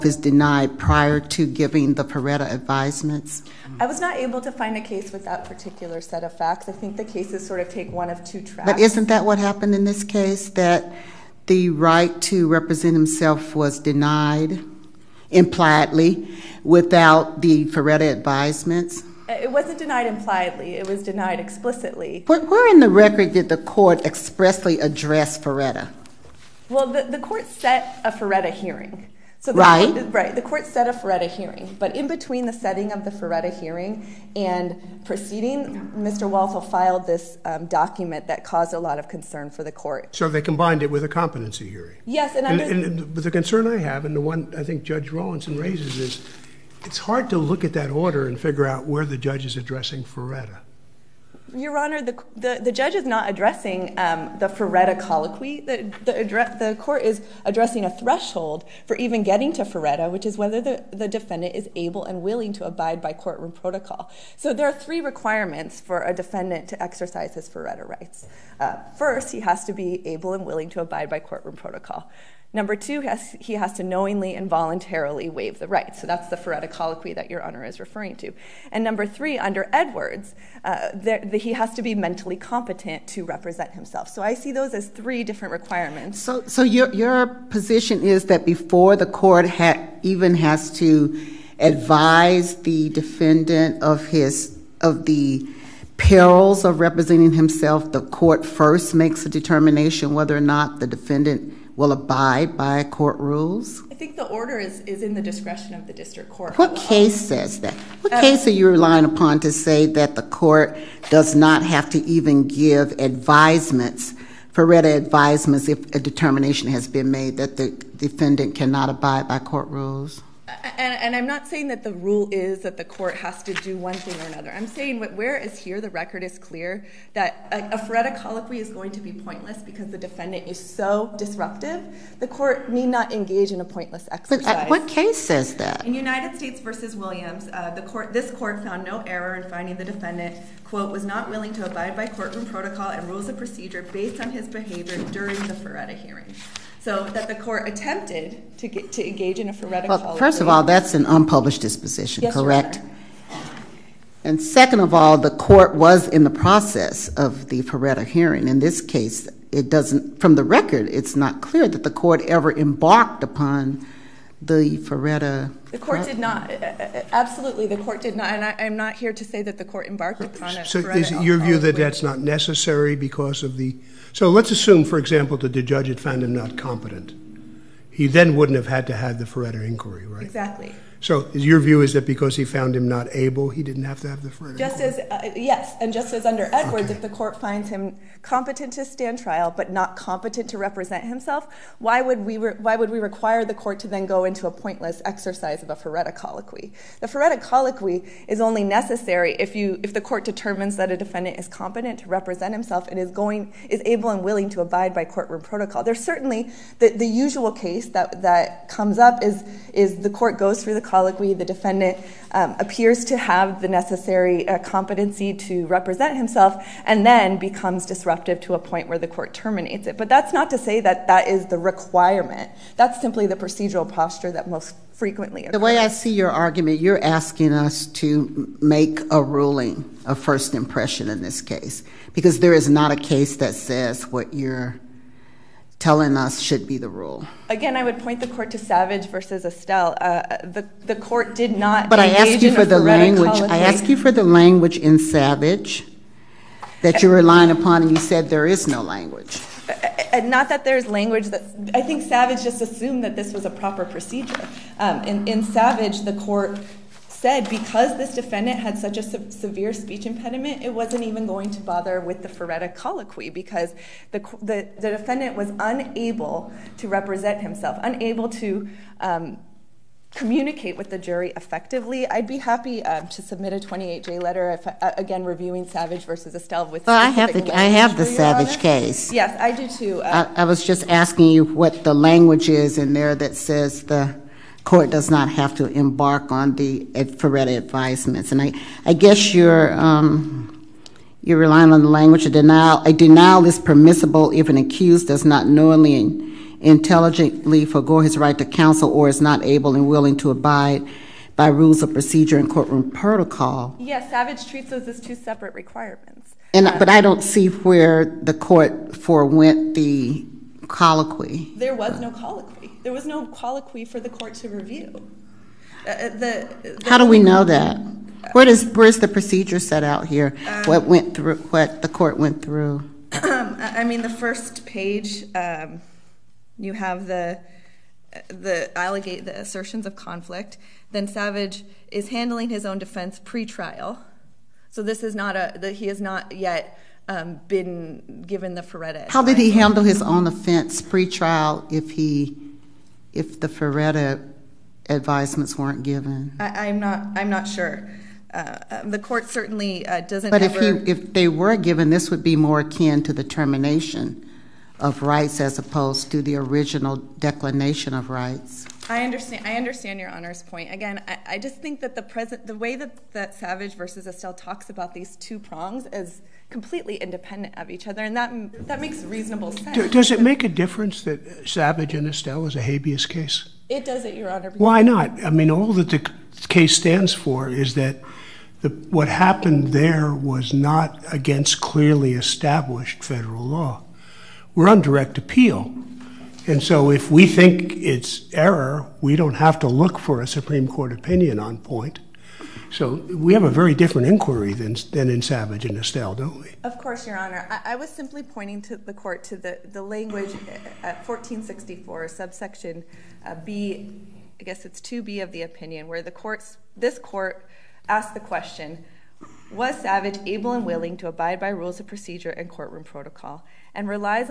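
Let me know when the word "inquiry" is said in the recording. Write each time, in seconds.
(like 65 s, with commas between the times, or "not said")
179 s, 394 s.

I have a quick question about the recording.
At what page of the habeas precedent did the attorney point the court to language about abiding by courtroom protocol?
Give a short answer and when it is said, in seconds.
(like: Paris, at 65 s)
1464, at 401 s.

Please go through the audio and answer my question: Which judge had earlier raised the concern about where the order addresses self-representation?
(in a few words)
Judge Rawlinson.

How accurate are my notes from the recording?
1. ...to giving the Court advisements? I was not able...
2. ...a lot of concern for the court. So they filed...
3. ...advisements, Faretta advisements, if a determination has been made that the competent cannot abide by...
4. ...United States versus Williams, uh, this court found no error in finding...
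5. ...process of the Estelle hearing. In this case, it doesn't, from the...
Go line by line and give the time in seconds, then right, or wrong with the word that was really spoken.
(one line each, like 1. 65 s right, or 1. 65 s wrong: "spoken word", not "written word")
1. 1 s wrong: "Faretta", not "Court"
2. 38 s wrong: "combined", not "filed"
3. 112 s wrong: "defendant", not "competent"
4. 135 s right
5. 156 s wrong: "Faretta", not "Estelle".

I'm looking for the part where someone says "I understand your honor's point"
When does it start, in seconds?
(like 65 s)
359 s.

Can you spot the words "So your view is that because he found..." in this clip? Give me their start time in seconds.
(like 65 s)
181 s.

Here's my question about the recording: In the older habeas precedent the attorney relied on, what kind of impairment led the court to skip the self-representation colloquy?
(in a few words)
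speech impediment.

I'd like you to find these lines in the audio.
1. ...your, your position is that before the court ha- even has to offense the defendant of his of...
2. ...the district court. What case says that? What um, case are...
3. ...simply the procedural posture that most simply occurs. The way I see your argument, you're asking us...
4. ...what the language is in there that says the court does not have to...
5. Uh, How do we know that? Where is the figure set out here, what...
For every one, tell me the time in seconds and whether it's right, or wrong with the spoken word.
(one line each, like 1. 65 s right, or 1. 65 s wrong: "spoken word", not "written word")
1. 86 s wrong: "advise", not "offense"
2. 105 s right
3. 223 s wrong: "frequently", not "simply"
4. 281 s right
5. 315 s wrong: "procedure", not "figure".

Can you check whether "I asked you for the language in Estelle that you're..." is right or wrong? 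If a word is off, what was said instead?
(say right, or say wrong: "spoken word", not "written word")
wrong: "Savage", not "Estelle".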